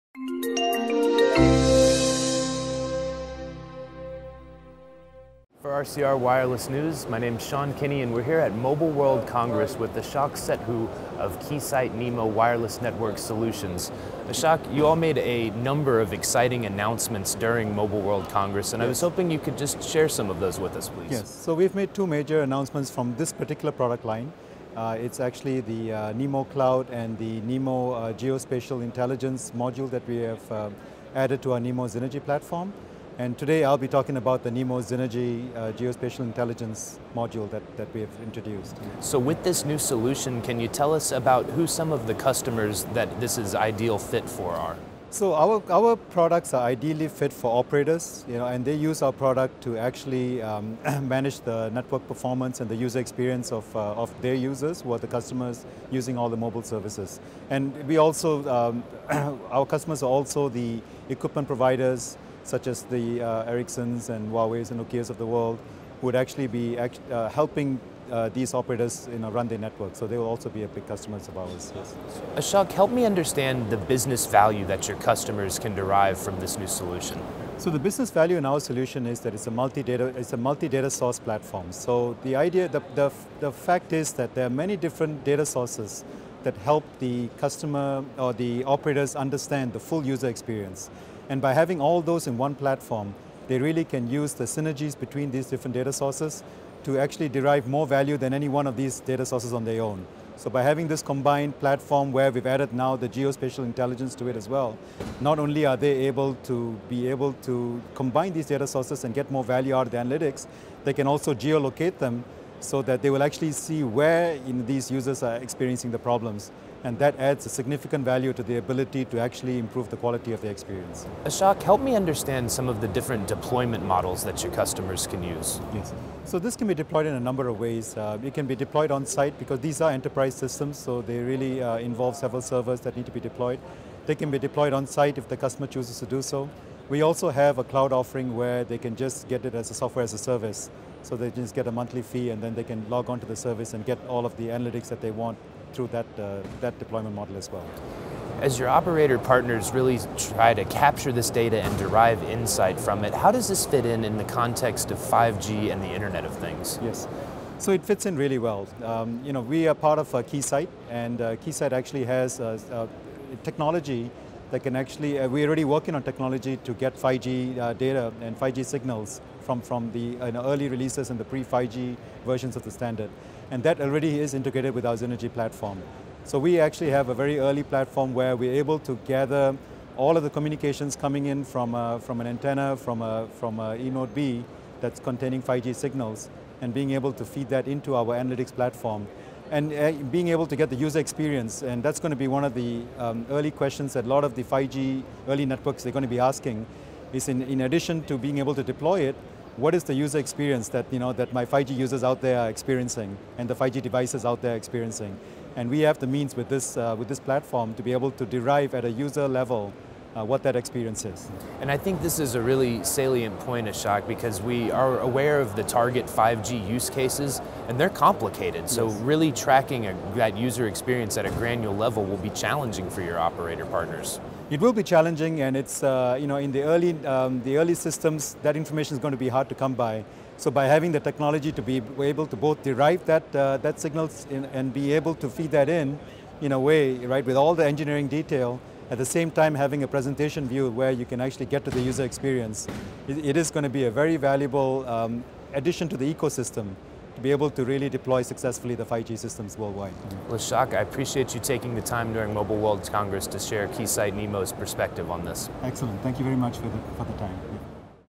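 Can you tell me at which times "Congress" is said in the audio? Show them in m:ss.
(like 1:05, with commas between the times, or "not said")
0:09, 0:18, 4:12.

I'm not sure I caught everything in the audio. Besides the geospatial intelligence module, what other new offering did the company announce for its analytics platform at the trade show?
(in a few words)
Nemo Cloud.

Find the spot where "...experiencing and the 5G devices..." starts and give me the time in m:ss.
3:22.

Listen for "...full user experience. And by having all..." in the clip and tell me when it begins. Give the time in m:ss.
1:29.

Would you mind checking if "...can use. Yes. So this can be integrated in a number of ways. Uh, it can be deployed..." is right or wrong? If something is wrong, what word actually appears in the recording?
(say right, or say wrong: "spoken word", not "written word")
wrong: "deployed", not "integrated".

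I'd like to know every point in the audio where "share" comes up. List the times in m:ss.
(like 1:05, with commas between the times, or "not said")
0:19, 4:13.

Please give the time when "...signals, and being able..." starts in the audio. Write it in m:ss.
3:05.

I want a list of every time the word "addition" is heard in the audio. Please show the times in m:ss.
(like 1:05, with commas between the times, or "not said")
3:17, 4:05.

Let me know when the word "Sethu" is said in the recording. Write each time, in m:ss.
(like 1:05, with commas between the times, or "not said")
0:10.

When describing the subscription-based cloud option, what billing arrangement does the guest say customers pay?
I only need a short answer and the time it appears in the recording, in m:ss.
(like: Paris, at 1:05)
A monthly fee, at 2:21.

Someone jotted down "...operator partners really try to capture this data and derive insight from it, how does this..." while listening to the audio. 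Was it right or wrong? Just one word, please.
right.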